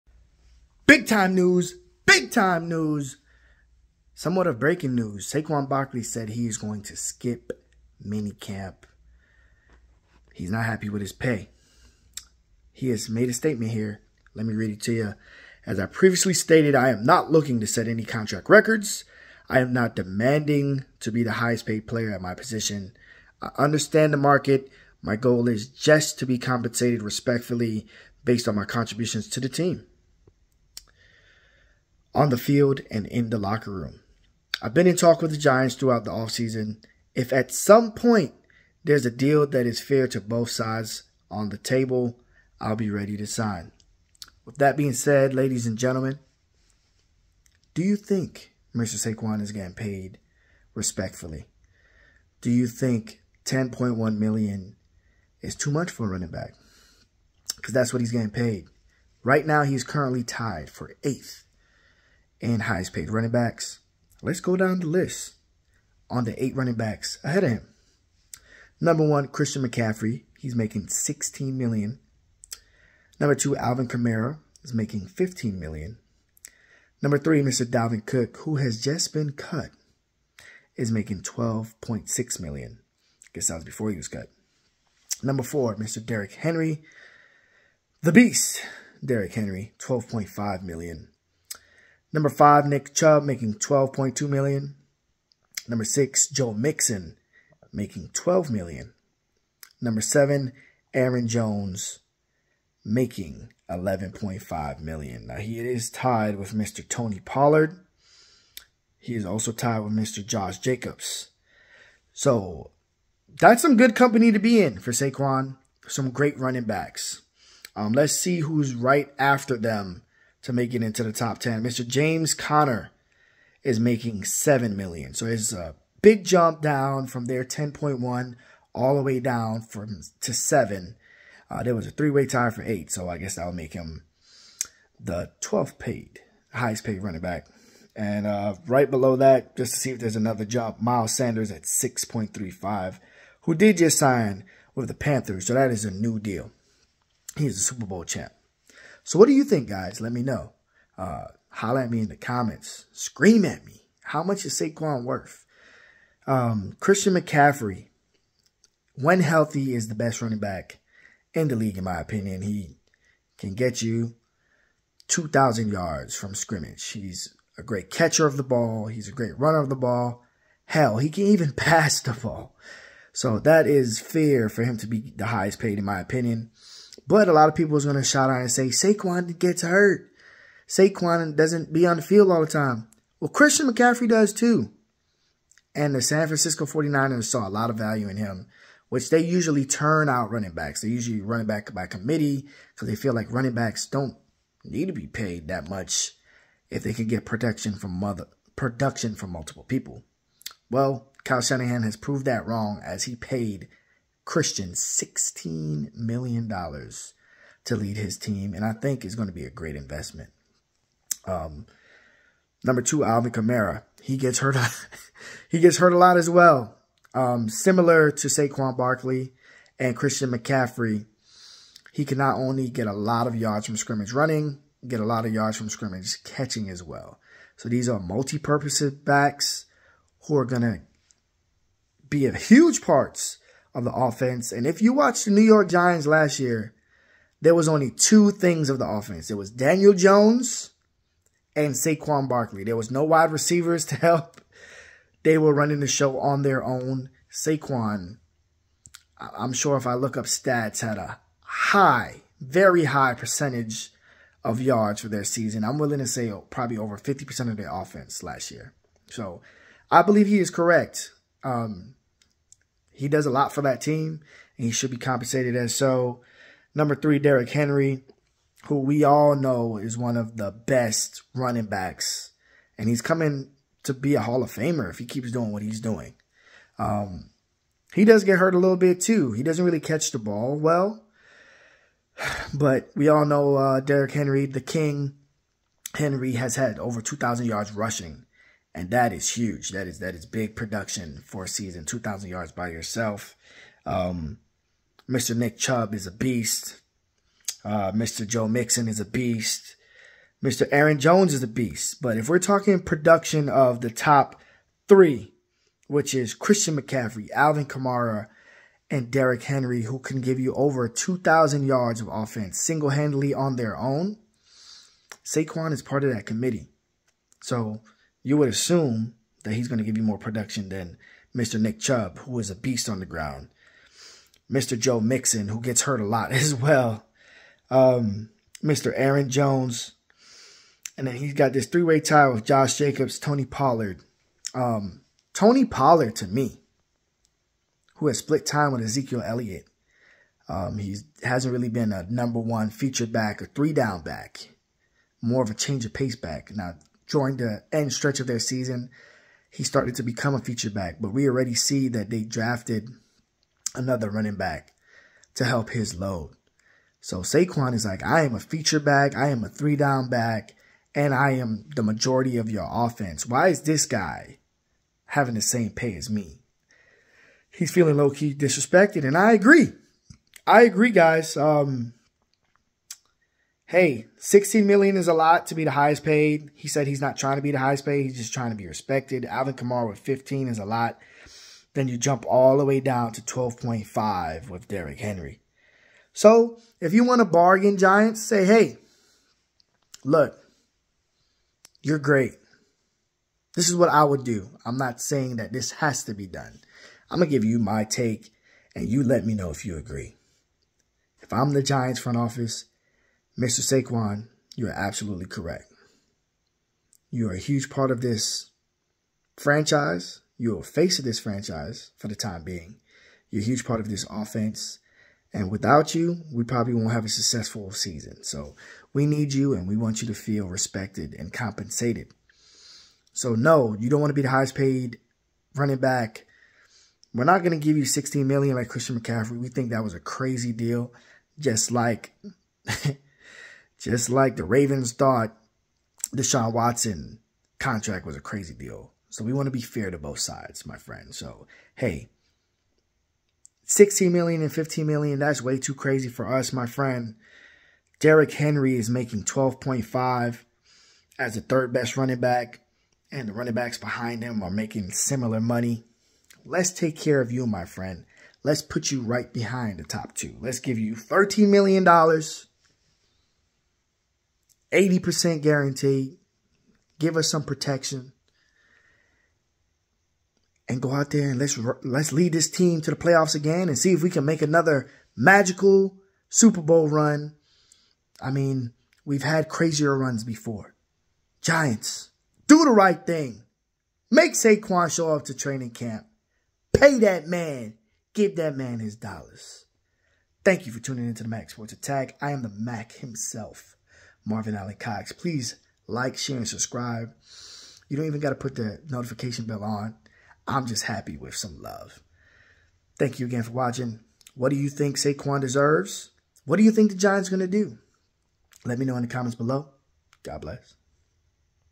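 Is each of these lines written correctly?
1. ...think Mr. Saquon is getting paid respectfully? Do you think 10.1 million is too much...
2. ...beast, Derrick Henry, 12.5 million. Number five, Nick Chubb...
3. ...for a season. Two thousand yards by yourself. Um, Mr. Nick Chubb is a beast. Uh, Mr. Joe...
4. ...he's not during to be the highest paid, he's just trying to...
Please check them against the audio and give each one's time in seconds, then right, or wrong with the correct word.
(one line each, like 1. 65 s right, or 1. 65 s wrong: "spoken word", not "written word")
1. 47 s right
2. 88 s right
3. 291 s right
4. 376 s wrong: "trying", not "during".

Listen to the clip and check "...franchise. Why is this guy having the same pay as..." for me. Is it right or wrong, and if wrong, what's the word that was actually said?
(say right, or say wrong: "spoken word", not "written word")
wrong: "offense", not "franchise".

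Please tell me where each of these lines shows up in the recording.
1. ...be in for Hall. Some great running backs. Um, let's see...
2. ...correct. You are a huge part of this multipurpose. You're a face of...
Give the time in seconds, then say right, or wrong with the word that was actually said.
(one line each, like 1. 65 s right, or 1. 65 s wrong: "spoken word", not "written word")
1. 114 s wrong: "Saquon", not "Hall"
2. 405 s wrong: "franchise", not "multipurpose".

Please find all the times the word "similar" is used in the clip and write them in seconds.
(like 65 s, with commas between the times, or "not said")
217 s, 454 s.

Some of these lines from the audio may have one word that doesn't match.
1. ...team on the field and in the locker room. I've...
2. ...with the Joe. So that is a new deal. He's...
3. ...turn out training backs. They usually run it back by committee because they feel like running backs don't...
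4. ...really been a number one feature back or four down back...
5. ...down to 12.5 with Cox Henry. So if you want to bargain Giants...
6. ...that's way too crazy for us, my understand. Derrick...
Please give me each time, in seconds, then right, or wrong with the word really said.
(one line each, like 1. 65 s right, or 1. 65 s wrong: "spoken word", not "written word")
1. 29 s right
2. 144 s wrong: "Panthers", not "Joe"
3. 189 s wrong: "running", not "training"
4. 341 s wrong: "three", not "four"
5. 382 s wrong: "Derrick", not "Cox"
6. 445 s wrong: "friend", not "understand".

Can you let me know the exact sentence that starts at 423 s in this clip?
So no, you don't want to be the highest paid running back.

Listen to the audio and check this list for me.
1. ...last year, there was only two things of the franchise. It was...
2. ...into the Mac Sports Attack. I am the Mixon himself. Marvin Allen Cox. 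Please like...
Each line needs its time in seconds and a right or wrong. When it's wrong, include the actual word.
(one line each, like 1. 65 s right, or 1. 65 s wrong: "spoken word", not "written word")
1. 236 s wrong: "offense", not "franchise"
2. 491 s wrong: "Mac", not "Mixon".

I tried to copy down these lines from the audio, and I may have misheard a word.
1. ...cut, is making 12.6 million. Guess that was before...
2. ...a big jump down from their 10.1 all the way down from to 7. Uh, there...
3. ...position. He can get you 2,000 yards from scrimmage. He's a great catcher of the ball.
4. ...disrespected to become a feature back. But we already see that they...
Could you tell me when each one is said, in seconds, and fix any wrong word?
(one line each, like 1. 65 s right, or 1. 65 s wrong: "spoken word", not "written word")
1. 79 s right
2. 125 s right
3. 161 s wrong: "opinion", not "position"
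4. 349 s wrong: "started", not "disrespected".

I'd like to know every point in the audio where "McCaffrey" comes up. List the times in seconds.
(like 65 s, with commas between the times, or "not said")
69 s, 157 s, 183 s, 220 s, 306 s, 428 s.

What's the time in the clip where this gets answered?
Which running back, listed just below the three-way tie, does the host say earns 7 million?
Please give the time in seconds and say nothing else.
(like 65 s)
121 s.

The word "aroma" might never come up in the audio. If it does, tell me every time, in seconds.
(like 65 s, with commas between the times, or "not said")
not said.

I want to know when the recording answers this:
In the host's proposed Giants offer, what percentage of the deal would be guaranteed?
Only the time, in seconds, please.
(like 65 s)
464 s.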